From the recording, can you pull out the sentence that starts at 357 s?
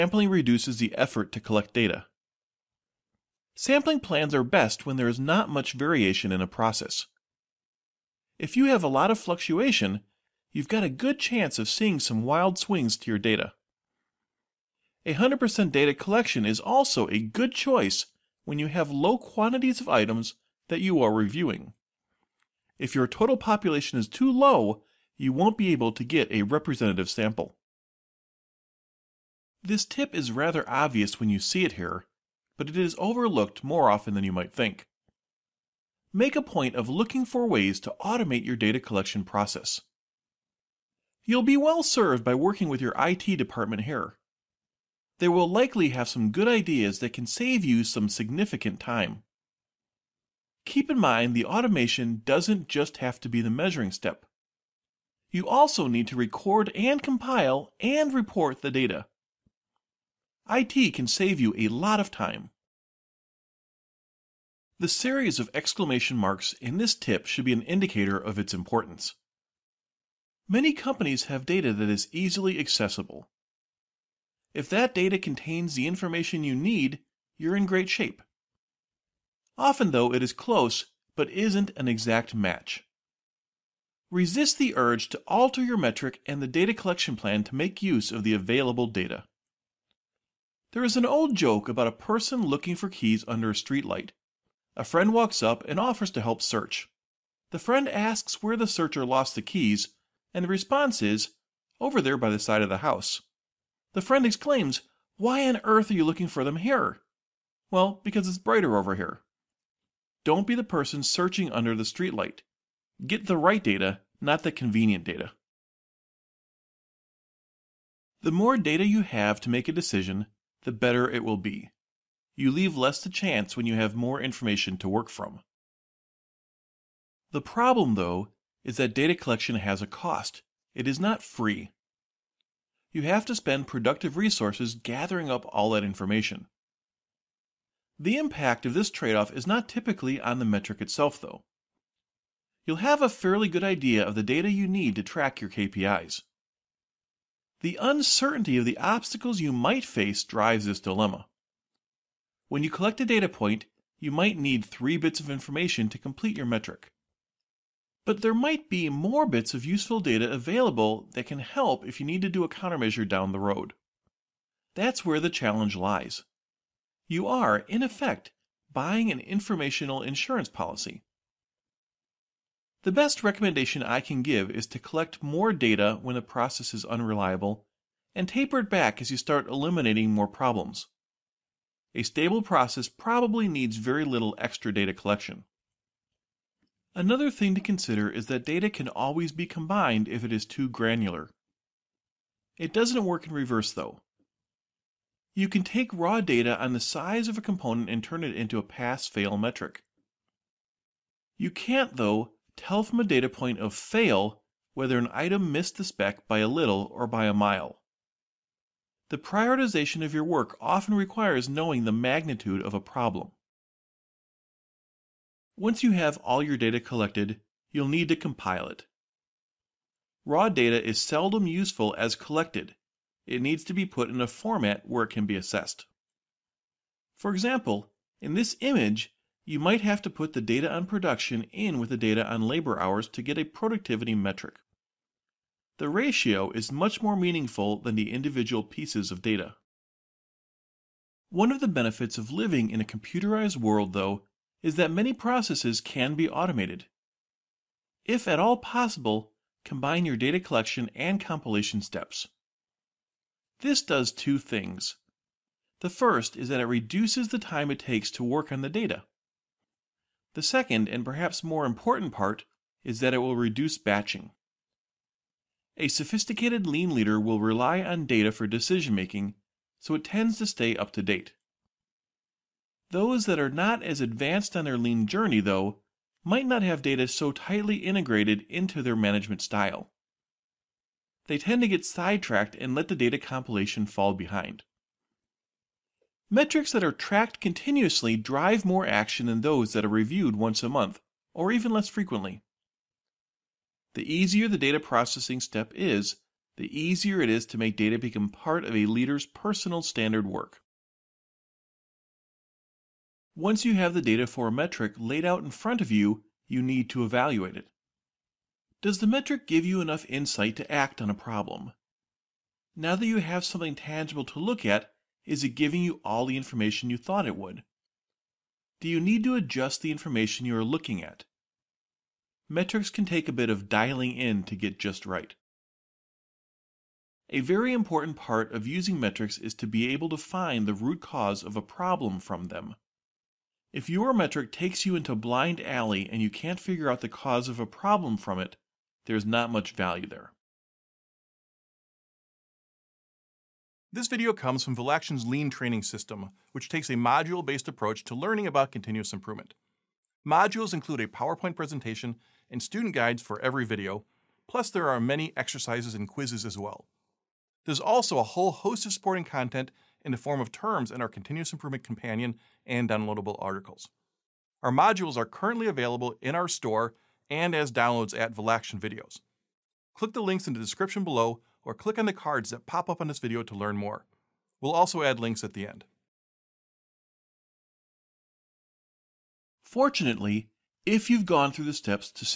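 There's also a whole host of supporting content in the form of terms in our Continuous Improvement Companion and downloadable articles.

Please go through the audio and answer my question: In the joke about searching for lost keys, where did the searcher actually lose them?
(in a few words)
By the side of the house.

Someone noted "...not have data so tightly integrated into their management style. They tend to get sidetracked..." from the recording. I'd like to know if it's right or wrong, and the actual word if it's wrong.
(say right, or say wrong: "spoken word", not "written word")
right.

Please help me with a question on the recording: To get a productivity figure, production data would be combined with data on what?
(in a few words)
Labor hours.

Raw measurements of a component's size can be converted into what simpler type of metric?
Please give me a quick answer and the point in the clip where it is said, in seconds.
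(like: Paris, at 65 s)
Pass-fail metric, at 198 s.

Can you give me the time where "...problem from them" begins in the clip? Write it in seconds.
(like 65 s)
331 s.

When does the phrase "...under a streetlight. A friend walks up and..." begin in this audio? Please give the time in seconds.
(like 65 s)
93 s.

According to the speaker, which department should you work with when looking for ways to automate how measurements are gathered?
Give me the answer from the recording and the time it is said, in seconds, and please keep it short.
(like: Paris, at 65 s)
IT department, at 42 s.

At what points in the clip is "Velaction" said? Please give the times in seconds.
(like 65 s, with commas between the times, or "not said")
344 s, 368 s.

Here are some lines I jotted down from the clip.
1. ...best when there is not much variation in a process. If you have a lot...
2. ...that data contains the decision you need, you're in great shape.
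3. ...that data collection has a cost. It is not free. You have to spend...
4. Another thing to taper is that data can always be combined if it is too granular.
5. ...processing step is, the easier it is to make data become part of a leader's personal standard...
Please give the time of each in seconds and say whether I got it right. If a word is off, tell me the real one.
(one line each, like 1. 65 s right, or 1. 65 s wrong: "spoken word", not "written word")
1. 4 s right
2. 74 s wrong: "information", not "decision"
3. 128 s right
4. 186 s wrong: "consider", not "taper"
5. 294 s right.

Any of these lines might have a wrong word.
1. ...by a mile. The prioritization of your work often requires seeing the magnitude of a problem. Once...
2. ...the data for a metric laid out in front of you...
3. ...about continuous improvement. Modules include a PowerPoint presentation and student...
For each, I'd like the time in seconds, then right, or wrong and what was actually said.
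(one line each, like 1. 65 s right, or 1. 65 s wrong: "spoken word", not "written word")
1. 207 s wrong: "knowing", not "seeing"
2. 303 s right
3. 348 s right.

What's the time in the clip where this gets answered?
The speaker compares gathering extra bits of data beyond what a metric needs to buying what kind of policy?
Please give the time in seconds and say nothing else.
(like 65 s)
169 s.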